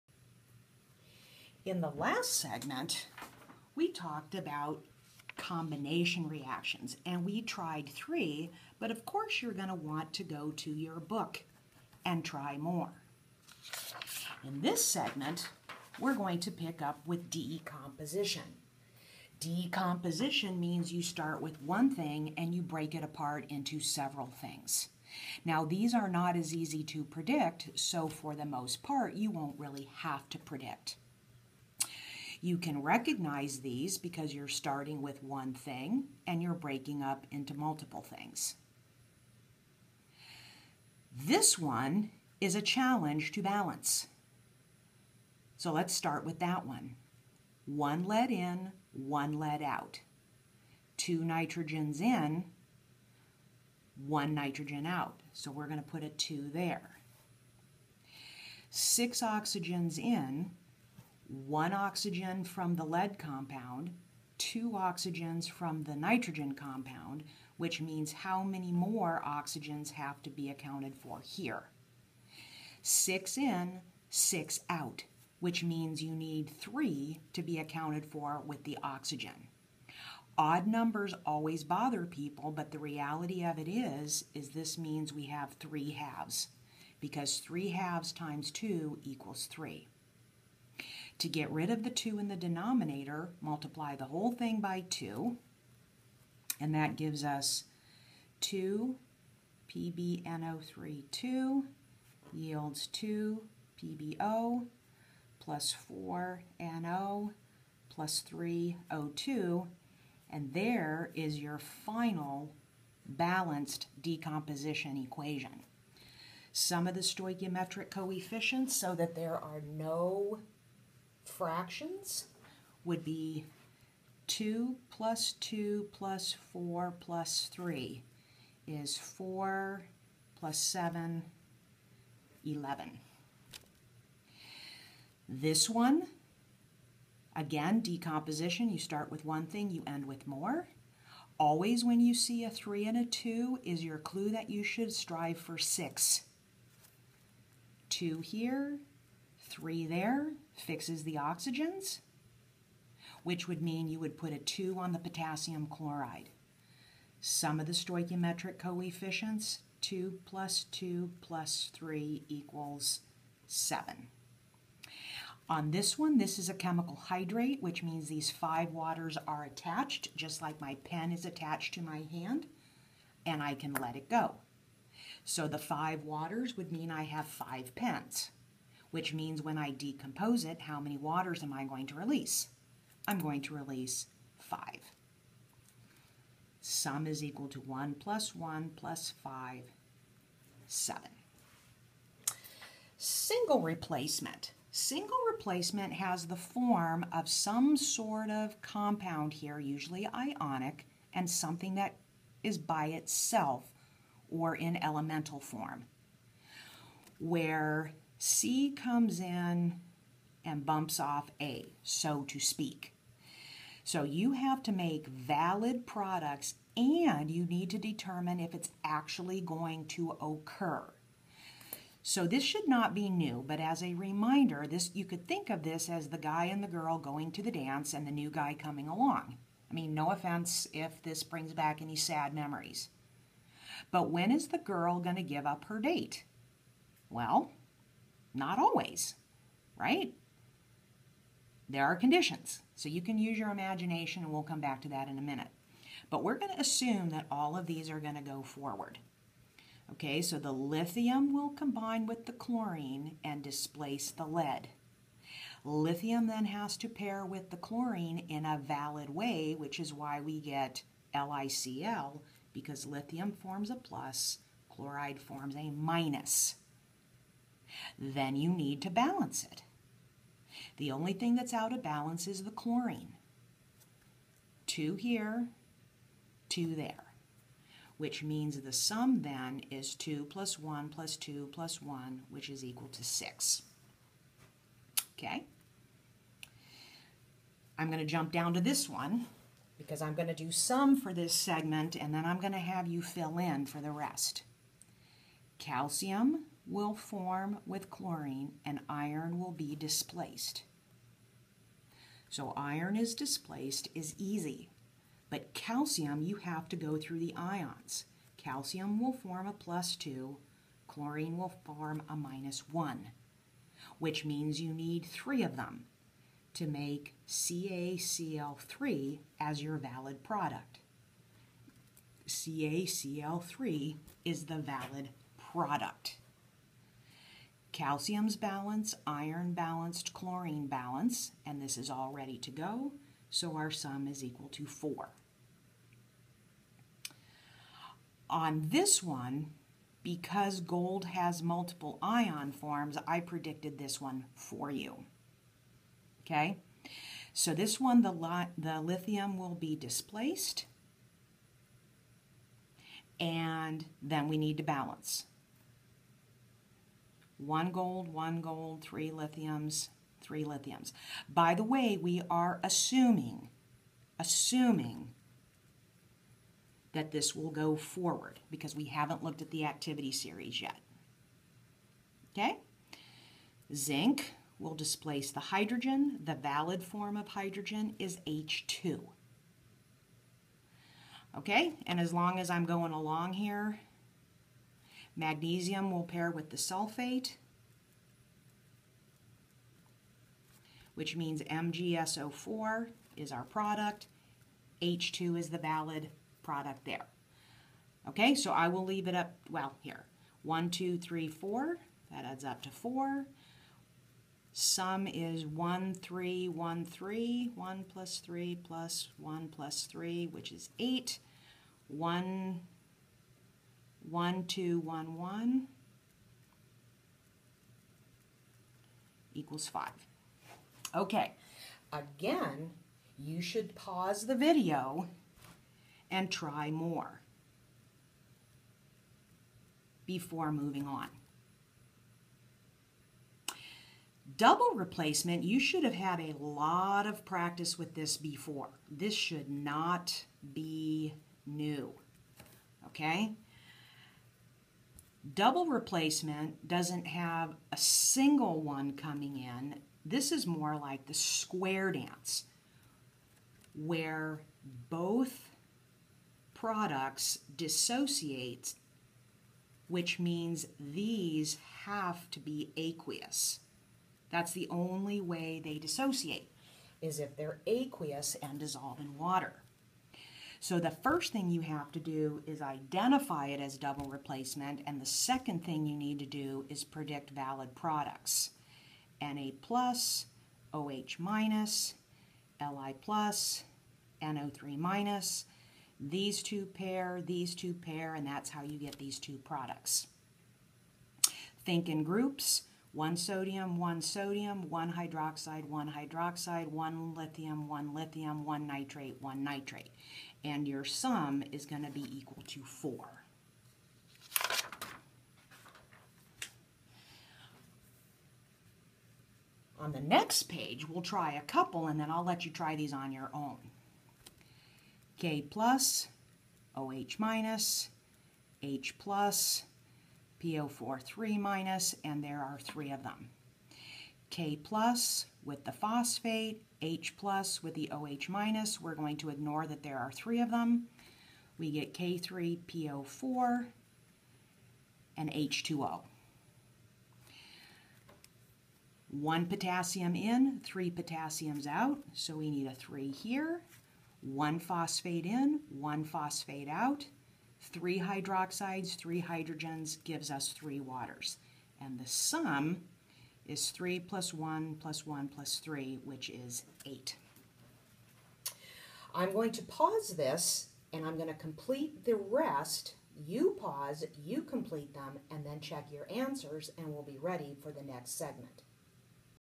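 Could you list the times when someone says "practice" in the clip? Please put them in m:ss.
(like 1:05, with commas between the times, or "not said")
7:17.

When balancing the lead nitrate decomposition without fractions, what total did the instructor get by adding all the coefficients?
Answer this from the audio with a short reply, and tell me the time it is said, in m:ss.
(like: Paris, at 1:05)
11, at 2:08.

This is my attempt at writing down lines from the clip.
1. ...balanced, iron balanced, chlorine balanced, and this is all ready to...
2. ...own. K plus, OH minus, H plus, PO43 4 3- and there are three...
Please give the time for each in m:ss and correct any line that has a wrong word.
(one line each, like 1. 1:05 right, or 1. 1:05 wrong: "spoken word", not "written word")
1. 5:28 right
2. 8:33 right.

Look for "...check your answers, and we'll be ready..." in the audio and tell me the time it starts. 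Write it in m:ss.
9:25.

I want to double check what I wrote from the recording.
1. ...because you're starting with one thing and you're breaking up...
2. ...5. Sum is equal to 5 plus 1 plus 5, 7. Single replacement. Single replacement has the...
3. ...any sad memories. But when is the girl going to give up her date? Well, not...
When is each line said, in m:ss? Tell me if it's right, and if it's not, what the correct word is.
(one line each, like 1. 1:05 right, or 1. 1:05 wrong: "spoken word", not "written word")
1. 0:33 right
2. 3:04 wrong: "1", not "5"
3. 3:51 right.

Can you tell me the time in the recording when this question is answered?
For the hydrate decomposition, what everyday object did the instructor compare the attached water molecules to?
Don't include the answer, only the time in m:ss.
2:50.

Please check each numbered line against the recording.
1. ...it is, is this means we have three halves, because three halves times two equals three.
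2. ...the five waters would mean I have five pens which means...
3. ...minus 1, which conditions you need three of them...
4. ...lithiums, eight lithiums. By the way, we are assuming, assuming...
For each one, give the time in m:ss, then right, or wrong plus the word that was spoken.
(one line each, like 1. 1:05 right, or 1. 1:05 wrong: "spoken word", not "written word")
1. 1:23 right
2. 2:55 right
3. 5:12 wrong: "means", not "conditions"
4. 5:59 wrong: "three", not "eight".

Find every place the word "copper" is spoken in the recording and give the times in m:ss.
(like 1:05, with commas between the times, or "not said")
not said.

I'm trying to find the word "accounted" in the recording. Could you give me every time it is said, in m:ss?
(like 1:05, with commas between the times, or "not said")
1:10, 1:17.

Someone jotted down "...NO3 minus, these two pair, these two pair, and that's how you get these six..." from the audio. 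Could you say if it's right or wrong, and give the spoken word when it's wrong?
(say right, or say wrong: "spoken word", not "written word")
wrong: "two", not "six".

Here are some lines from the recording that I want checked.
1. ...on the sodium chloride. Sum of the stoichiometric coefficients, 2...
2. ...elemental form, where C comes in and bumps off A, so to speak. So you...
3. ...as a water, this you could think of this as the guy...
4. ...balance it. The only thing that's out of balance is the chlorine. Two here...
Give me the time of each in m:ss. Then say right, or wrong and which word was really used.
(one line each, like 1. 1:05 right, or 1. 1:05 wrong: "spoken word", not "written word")
1. 2:34 wrong: "potassium", not "sodium"
2. 3:24 right
3. 3:43 wrong: "reminder", not "water"
4. 4:28 right.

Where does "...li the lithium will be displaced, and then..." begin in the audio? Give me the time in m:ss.
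5:48.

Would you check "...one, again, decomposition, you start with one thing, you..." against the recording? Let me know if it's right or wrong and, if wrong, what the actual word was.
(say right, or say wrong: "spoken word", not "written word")
right.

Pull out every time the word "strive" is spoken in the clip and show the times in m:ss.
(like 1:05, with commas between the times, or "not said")
2:24.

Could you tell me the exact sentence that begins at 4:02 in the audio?
So you can use your imagination, and we'll come back to that in a minute.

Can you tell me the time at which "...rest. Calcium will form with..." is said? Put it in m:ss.
4:53.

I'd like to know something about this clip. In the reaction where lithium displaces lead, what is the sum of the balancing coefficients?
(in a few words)
6.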